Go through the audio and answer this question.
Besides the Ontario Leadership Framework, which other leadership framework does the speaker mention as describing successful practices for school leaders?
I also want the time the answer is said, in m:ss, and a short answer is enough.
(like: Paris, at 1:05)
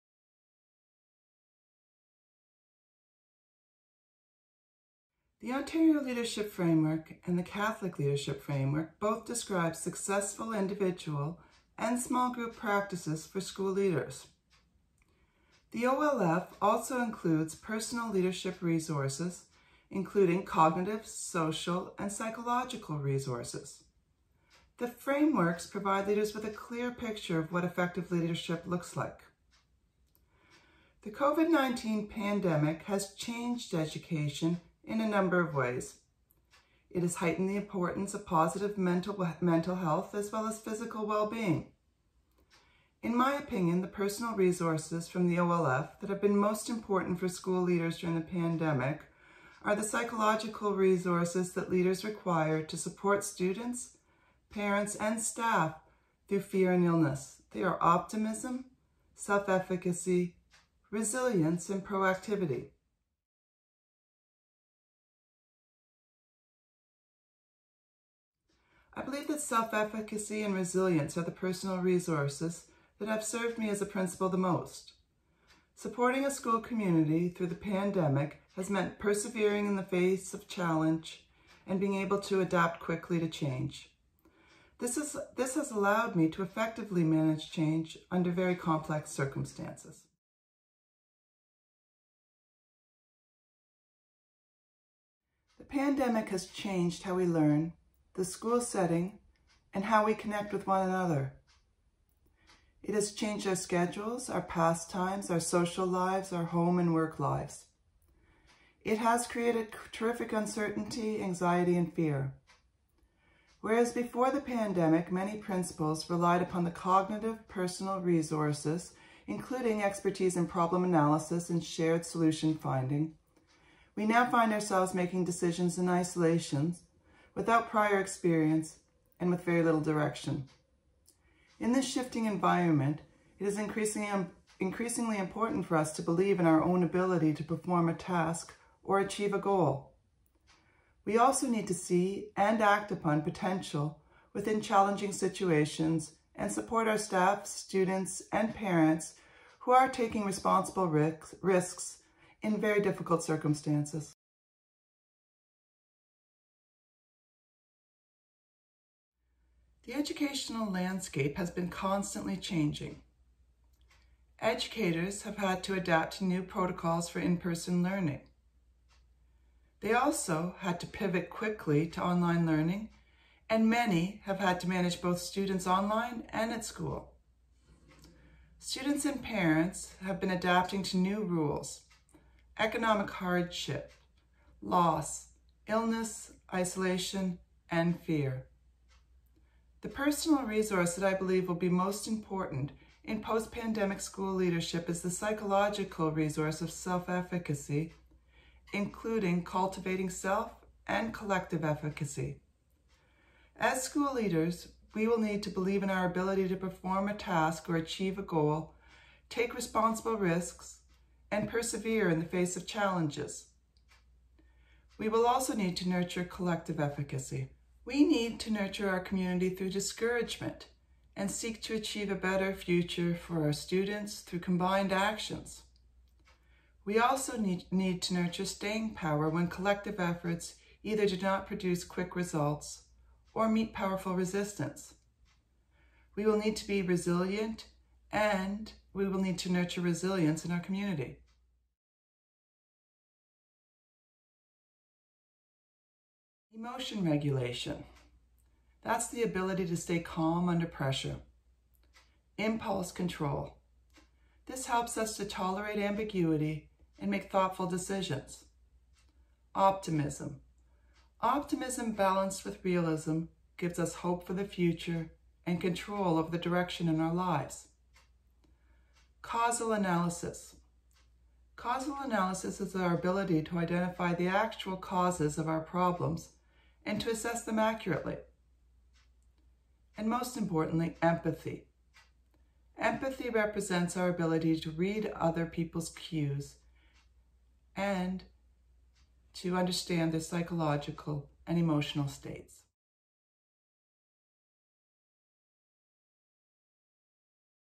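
Catholic Leadership Framework, at 0:07.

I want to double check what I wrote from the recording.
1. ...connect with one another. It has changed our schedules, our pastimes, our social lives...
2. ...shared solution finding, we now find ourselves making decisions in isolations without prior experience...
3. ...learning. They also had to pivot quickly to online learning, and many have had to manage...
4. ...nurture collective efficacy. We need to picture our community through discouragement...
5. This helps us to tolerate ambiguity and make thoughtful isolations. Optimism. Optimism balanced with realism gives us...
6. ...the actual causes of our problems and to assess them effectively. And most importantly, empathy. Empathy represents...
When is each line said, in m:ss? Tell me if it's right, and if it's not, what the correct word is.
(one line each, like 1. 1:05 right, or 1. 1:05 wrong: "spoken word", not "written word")
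1. 1:40 right
2. 2:01 right
3. 2:47 right
4. 3:35 wrong: "nurture", not "picture"
5. 4:14 wrong: "decisions", not "isolations"
6. 4:34 wrong: "accurately", not "effectively".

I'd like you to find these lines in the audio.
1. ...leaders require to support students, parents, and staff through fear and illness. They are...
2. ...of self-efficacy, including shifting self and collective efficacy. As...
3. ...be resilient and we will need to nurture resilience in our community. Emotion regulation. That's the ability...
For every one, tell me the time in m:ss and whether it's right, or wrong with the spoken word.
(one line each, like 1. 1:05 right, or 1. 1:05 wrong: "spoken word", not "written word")
1. 0:51 right
2. 3:16 wrong: "cultivating", not "shifting"
3. 3:56 right.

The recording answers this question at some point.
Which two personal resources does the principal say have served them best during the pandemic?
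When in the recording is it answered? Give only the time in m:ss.
1:09.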